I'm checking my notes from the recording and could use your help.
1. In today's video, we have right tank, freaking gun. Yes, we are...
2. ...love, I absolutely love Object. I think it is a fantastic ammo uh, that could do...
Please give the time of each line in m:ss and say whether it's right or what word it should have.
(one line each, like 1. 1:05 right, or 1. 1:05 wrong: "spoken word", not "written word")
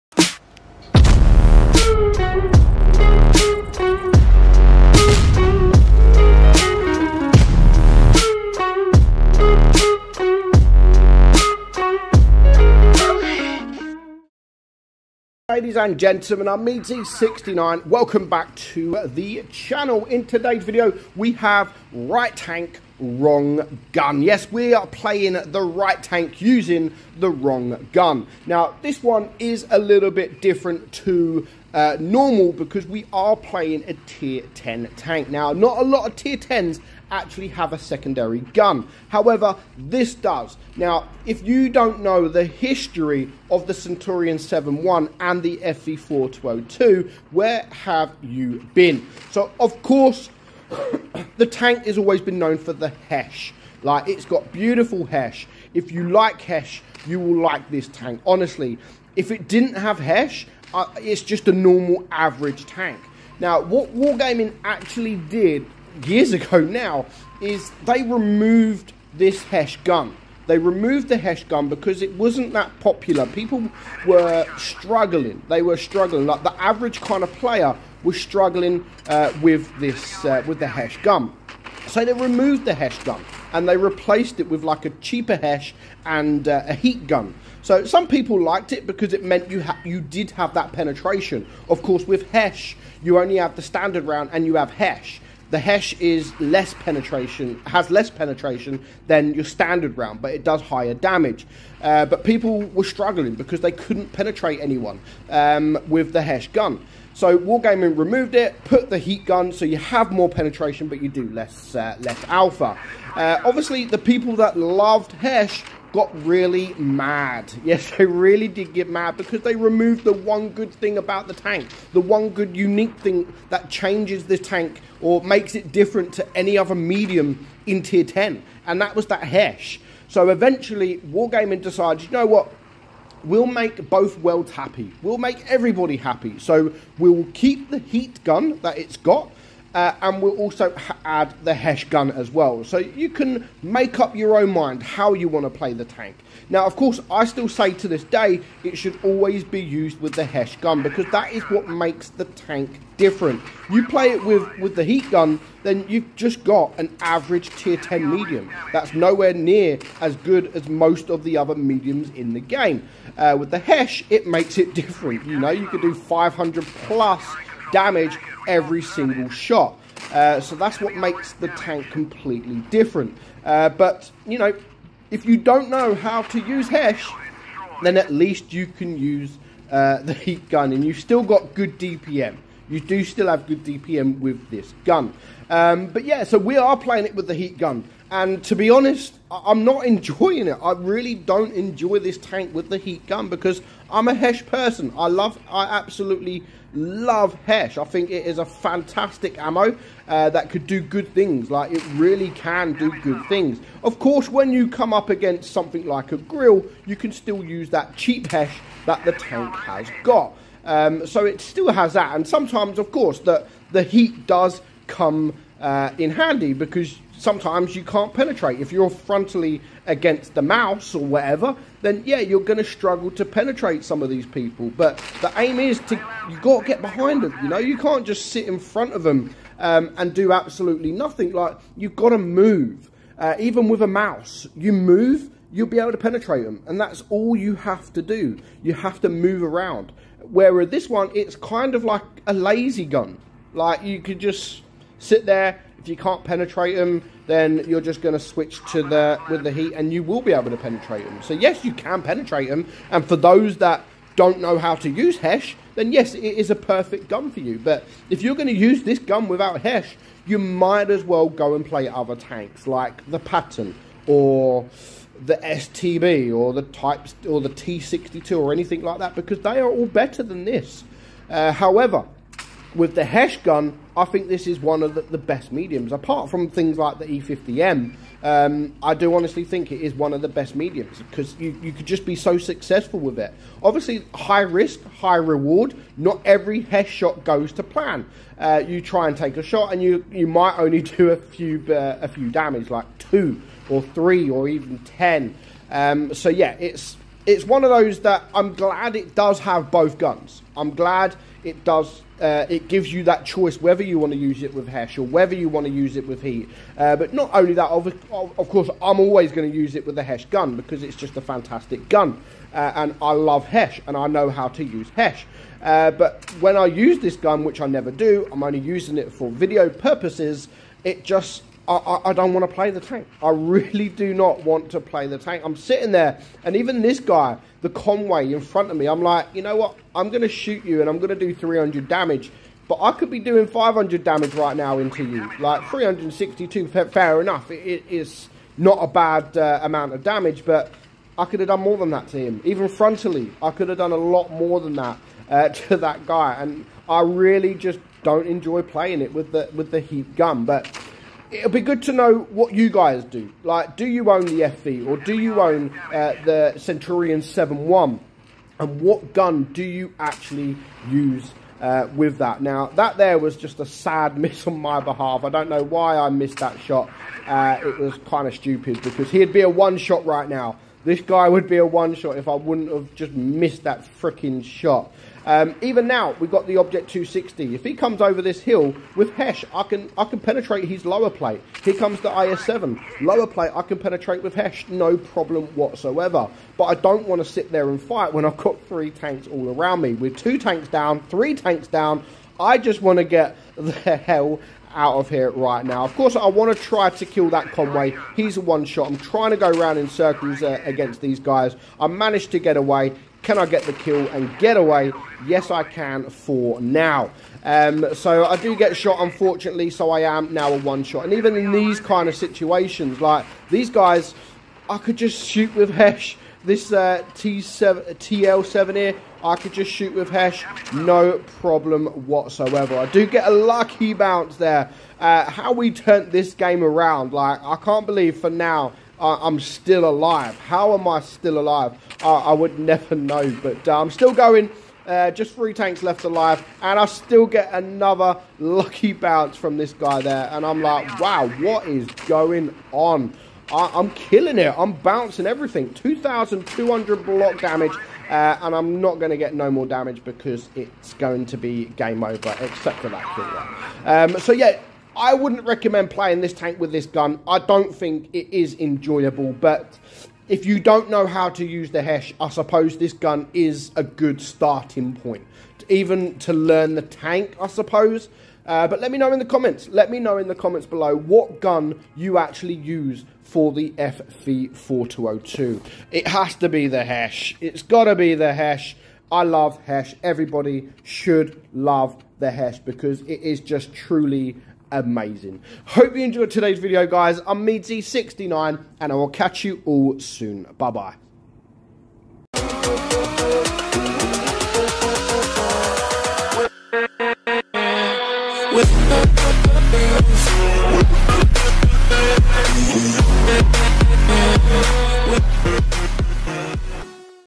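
1. 0:20 wrong: "wrong", not "freaking"
2. 3:15 wrong: "Hesh", not "Object".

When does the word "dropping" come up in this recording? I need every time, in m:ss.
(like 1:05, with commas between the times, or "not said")
not said.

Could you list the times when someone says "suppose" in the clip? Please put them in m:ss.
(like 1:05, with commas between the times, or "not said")
7:42, 7:47.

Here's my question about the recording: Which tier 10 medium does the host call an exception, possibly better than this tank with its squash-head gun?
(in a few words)
E50M.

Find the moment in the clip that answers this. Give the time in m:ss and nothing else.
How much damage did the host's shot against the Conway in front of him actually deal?
5:35.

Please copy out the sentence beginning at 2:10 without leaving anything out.
So eventually, Wargaming decided, you know what?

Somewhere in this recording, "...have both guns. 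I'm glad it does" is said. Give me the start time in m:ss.
4:59.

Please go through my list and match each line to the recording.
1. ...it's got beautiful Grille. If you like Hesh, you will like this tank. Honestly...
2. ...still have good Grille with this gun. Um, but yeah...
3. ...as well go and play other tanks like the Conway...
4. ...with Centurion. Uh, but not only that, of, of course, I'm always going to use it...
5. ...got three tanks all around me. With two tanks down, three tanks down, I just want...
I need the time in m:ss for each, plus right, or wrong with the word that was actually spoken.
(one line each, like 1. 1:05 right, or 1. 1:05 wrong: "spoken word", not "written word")
1. 0:54 wrong: "Hesh", not "Grille"
2. 3:03 wrong: "DPM", not "Grille"
3. 4:20 wrong: "Patton", not "Conway"
4. 5:06 wrong: "Heat", not "Centurion"
5. 6:28 right.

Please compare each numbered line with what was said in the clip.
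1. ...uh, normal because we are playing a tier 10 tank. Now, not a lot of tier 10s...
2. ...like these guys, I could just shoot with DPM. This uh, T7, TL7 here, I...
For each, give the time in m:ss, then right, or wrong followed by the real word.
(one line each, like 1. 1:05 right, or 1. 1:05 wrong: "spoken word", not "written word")
1. 0:31 right
2. 6:52 wrong: "Hesh", not "DPM".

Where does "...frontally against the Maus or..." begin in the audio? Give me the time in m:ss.
3:38.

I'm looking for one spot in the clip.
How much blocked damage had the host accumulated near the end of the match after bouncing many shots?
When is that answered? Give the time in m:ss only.
7:25.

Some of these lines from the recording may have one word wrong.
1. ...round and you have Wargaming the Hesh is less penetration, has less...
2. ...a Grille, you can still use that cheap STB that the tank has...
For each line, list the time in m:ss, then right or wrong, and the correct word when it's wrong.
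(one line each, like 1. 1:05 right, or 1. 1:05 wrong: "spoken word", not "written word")
1. 1:34 wrong: "Hesh", not "Wargaming"
2. 3:26 wrong: "Hesh", not "STB".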